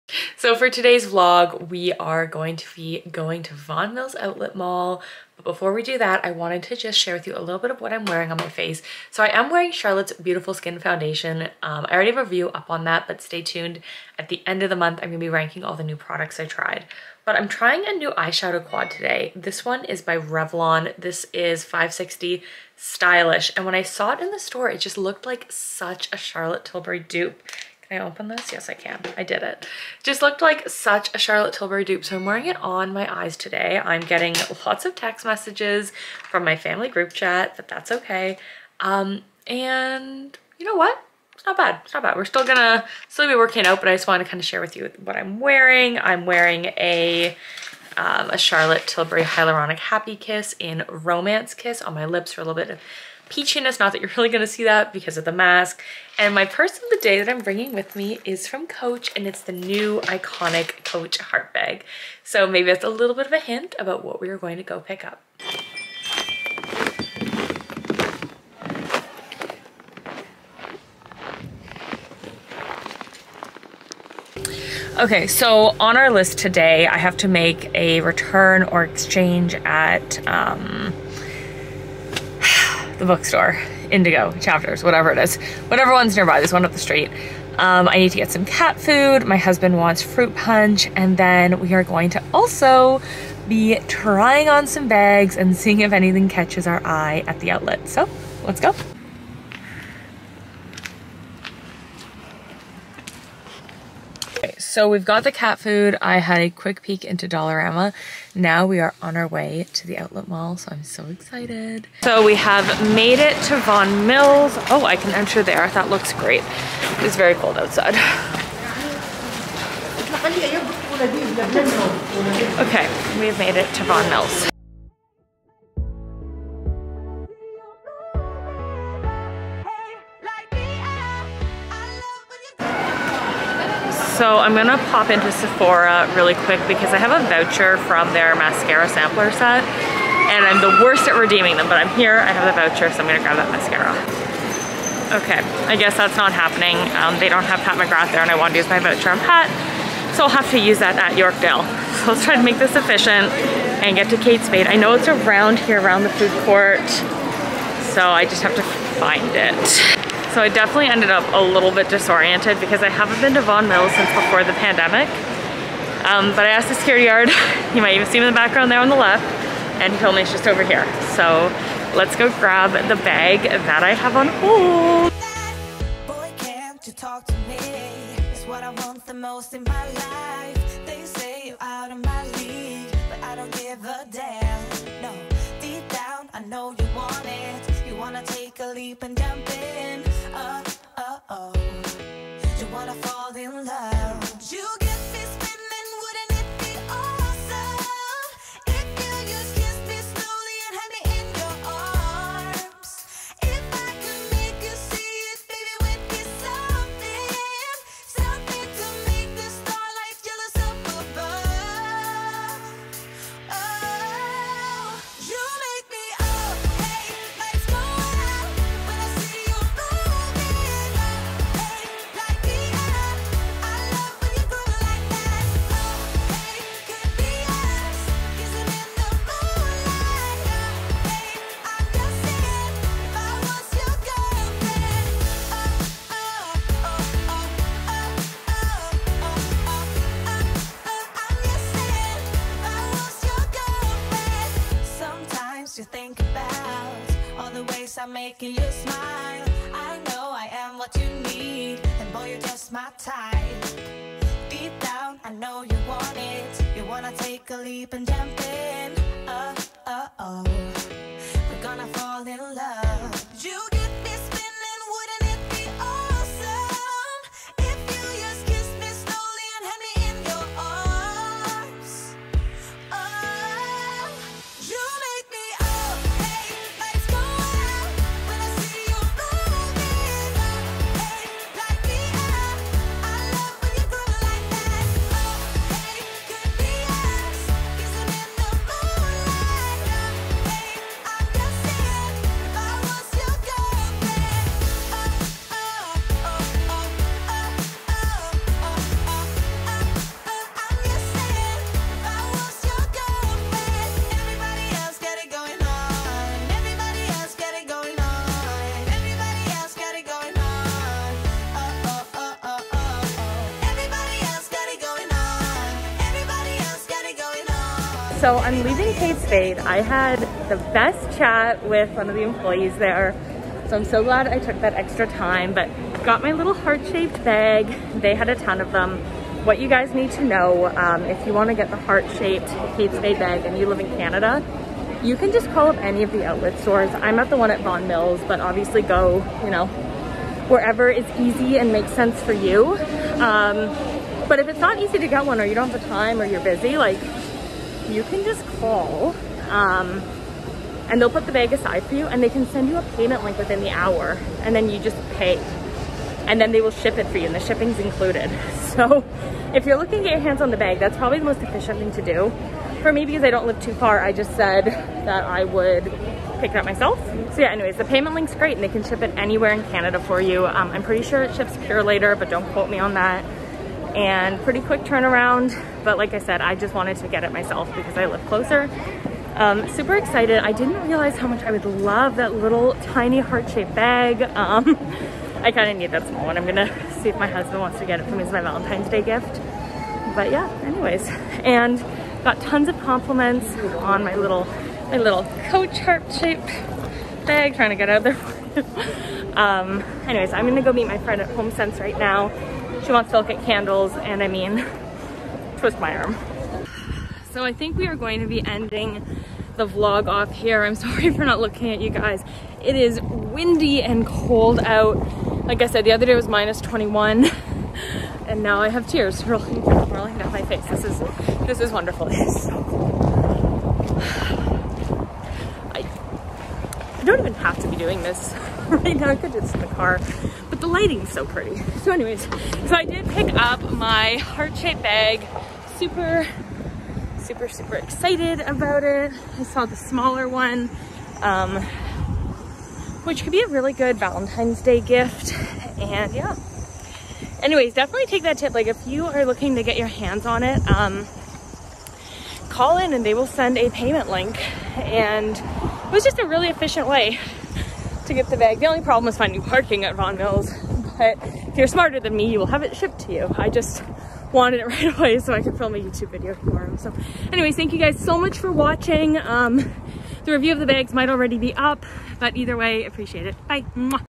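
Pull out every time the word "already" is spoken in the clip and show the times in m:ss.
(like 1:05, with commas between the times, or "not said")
0:11, 7:51.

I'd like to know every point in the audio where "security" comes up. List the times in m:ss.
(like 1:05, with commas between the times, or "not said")
2:46.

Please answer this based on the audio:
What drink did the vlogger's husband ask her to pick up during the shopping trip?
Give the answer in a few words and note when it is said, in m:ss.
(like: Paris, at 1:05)
Fruit punch, at 1:30.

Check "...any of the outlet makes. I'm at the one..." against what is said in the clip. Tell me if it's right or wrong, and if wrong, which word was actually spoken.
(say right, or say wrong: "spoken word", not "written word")
wrong: "stores", not "makes".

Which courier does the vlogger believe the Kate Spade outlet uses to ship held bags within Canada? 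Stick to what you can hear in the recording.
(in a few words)
Purolator.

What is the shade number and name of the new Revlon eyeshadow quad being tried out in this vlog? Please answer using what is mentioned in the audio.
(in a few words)
560 Stylish.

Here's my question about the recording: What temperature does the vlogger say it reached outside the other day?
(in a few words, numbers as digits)
-21.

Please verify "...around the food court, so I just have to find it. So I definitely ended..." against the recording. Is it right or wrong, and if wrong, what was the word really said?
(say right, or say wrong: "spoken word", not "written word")
right.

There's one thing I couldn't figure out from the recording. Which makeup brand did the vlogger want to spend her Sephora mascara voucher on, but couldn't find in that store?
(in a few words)
Pat McGrath.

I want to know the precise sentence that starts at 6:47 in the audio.
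So I think we are going to be ending the vlog off here.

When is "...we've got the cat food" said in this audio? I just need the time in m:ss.
1:44.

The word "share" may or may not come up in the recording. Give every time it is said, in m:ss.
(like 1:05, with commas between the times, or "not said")
0:06, 0:44.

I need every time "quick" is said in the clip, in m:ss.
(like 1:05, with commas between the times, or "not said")
1:46, 2:16, 6:14.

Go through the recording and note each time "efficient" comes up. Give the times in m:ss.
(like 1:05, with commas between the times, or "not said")
2:32, 6:01, 7:36.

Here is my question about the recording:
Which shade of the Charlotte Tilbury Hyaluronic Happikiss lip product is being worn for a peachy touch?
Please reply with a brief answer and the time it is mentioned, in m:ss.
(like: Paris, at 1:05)
Romance Kiss, at 0:50.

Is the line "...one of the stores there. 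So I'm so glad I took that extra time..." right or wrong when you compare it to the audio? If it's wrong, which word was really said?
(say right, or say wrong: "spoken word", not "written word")
wrong: "employees", not "stores".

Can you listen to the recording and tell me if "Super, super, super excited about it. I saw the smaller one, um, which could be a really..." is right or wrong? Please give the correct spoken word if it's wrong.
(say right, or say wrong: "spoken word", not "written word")
right.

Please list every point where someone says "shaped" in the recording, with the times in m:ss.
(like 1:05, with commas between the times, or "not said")
5:26, 5:31, 6:23, 6:35, 7:14.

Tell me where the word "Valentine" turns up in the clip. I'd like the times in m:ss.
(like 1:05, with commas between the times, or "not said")
6:28, 7:23.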